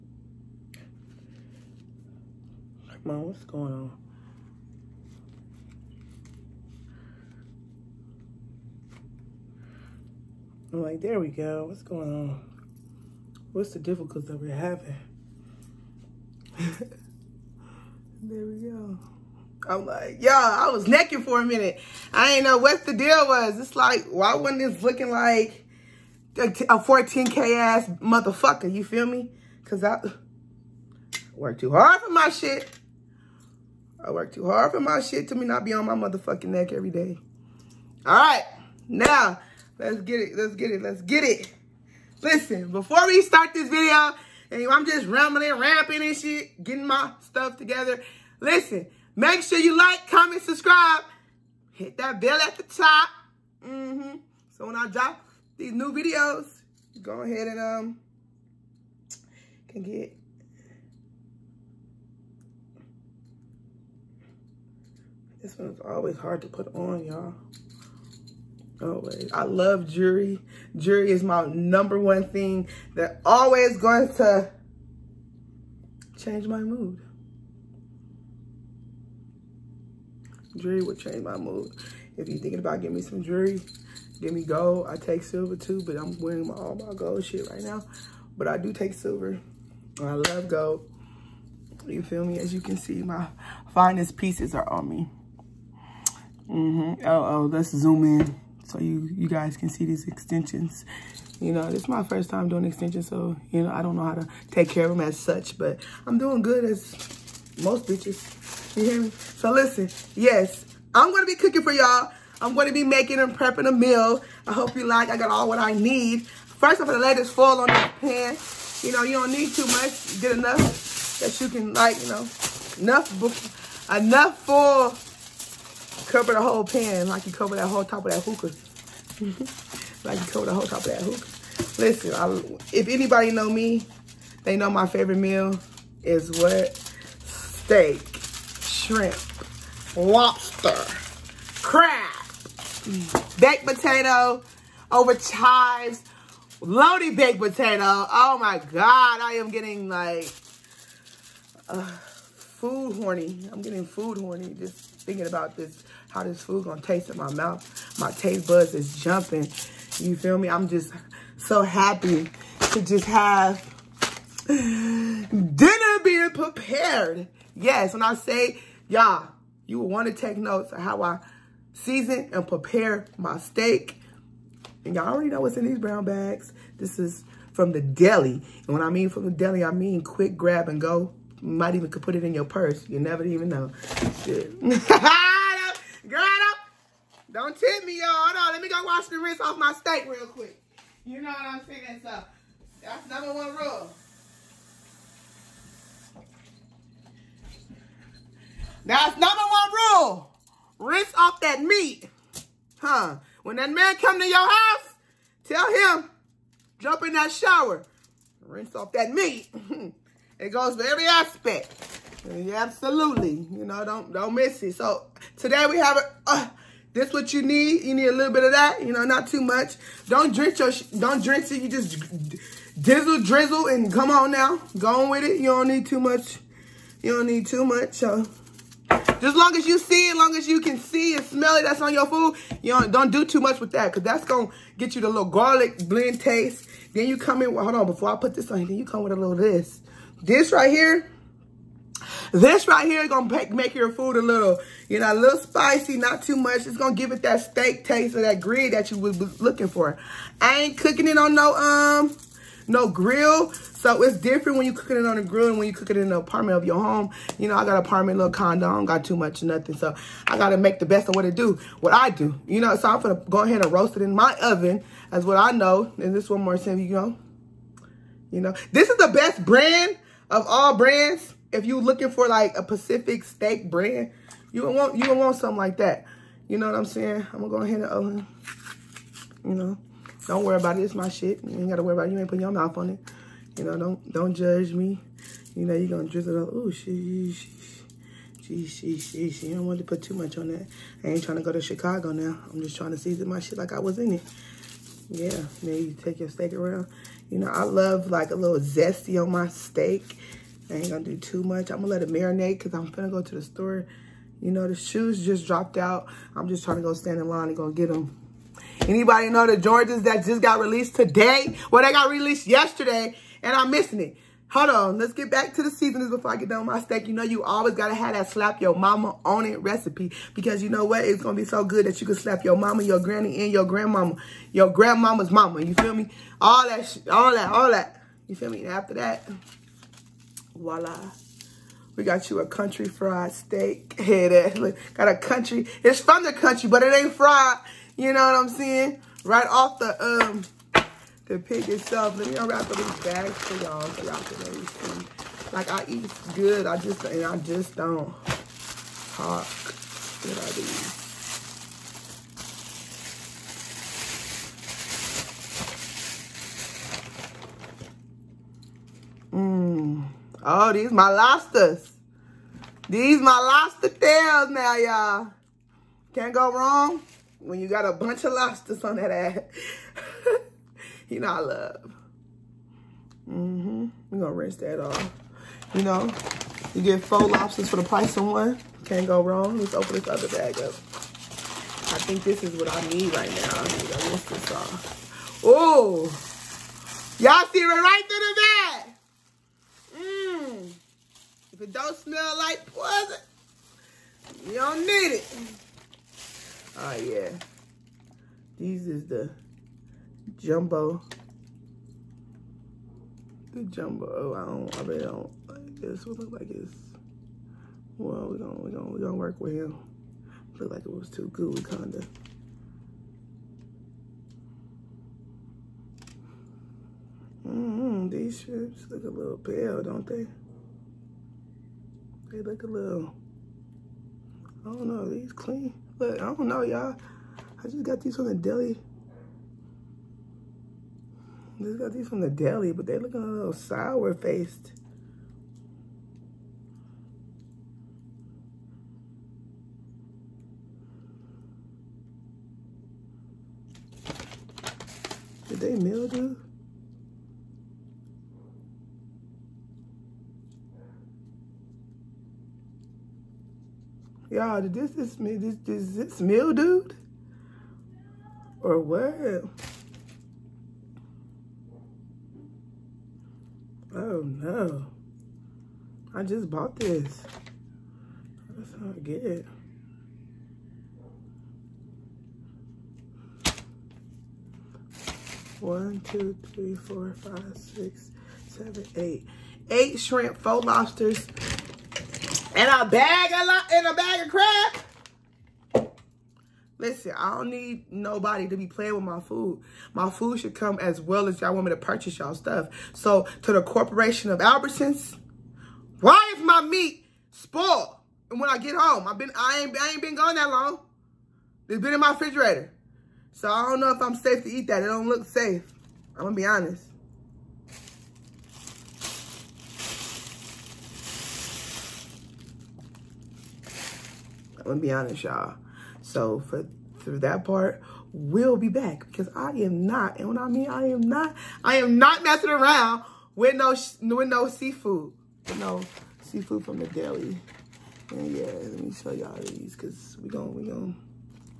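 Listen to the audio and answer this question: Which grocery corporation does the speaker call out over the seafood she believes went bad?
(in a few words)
Albertsons.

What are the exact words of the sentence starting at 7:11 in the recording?
These got these from the deli, but they looking a little sour faced.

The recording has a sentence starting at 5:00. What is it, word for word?
I ain't gonna do too much.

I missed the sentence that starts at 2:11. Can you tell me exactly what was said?
Listen, I, if anybody know me, they know my favorite meal is what?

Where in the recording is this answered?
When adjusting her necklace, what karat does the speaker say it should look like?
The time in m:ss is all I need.
0:26.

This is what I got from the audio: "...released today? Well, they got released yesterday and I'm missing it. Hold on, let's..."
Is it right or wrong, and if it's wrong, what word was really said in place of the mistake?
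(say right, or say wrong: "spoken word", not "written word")
right.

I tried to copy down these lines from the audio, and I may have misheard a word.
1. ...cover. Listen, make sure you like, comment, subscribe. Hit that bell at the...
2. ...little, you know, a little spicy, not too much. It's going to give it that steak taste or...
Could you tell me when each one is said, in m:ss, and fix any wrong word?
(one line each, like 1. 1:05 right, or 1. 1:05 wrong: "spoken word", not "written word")
1. 0:47 wrong: "together", not "cover"
2. 4:04 right.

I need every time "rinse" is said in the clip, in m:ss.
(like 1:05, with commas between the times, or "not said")
3:09, 3:20, 3:28, 6:14, 6:24.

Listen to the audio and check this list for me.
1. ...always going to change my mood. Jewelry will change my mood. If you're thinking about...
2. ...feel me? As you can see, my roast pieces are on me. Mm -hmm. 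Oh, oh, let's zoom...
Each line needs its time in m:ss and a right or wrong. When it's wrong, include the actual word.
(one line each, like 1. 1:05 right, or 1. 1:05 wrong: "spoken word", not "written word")
1. 1:13 right
2. 1:32 wrong: "finest", not "roast".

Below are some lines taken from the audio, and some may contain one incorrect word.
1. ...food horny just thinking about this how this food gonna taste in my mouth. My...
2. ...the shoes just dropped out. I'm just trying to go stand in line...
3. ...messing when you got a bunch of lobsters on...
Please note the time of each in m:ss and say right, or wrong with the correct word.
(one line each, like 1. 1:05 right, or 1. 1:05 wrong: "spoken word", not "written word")
1. 2:33 right
2. 5:04 right
3. 6:06 wrong: "wrong", not "messing".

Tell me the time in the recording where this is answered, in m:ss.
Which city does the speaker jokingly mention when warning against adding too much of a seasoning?
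4:51.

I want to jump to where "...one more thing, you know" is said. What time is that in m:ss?
4:26.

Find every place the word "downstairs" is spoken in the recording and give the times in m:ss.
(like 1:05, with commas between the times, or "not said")
not said.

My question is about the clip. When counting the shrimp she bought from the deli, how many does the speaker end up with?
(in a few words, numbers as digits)
8.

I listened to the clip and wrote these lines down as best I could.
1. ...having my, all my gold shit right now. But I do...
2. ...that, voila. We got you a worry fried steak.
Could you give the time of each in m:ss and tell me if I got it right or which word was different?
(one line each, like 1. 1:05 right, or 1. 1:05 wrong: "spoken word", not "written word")
1. 1:26 wrong: "wearing", not "having"
2. 5:28 wrong: "country", not "worry".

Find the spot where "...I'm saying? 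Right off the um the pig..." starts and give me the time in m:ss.
5:38.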